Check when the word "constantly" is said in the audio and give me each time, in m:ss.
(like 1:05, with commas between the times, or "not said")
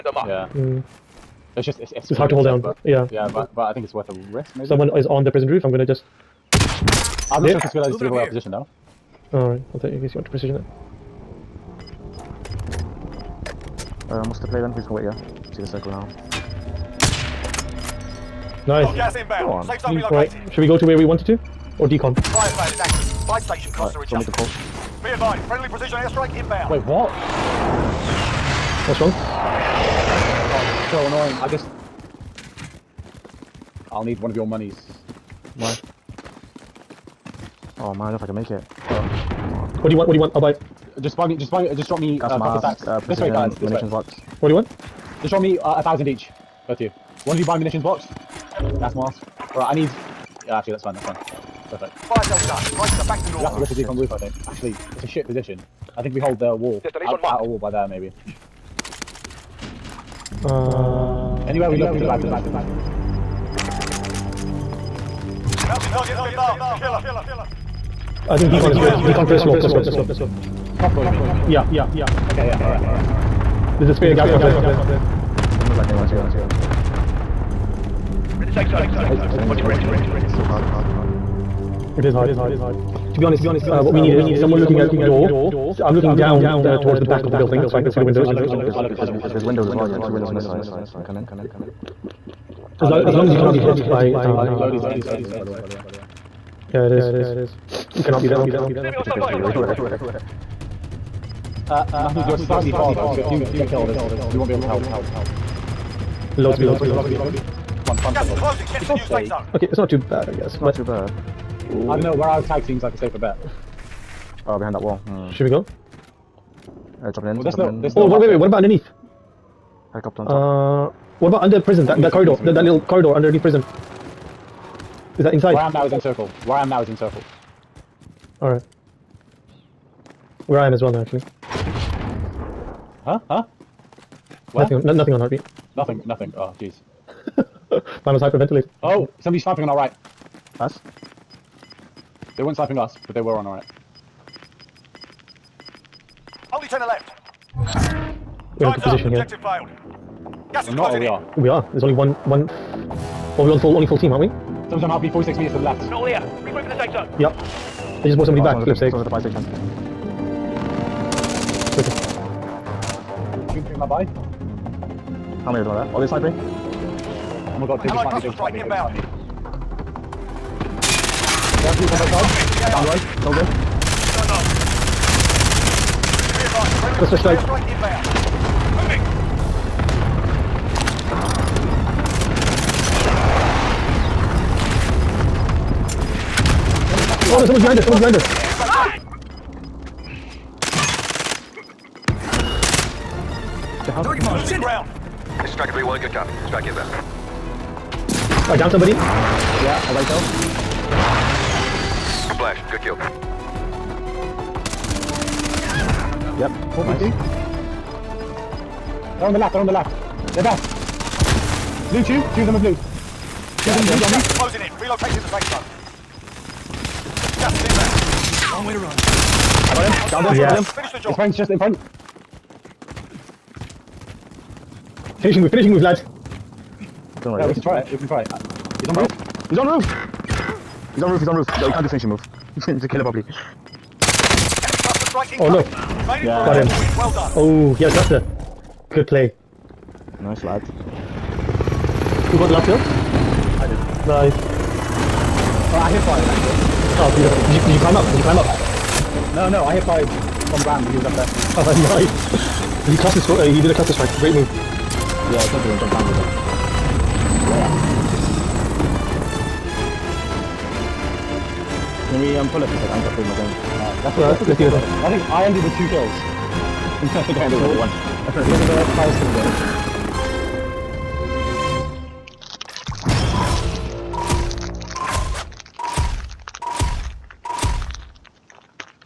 not said.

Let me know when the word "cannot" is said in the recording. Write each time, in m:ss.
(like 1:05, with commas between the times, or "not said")
1:33, 1:38.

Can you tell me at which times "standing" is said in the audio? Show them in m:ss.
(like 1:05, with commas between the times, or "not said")
1:19.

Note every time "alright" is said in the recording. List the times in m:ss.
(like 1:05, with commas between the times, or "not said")
0:09, 1:12, 2:08.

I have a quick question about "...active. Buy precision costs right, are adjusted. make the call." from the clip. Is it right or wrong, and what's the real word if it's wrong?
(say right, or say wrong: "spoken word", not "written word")
wrong: "station", not "precision".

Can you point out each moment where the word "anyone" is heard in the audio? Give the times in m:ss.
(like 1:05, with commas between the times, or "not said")
1:15.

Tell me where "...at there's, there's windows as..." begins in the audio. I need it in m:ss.
1:28.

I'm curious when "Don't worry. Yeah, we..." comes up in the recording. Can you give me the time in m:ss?
3:47.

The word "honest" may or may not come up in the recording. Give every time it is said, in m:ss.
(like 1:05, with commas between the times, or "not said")
1:23.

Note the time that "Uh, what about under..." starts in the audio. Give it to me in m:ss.
2:00.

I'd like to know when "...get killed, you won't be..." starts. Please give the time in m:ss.
1:43.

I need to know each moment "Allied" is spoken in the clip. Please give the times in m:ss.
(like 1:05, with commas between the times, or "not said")
2:47.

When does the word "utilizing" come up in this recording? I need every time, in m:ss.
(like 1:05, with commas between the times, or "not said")
not said.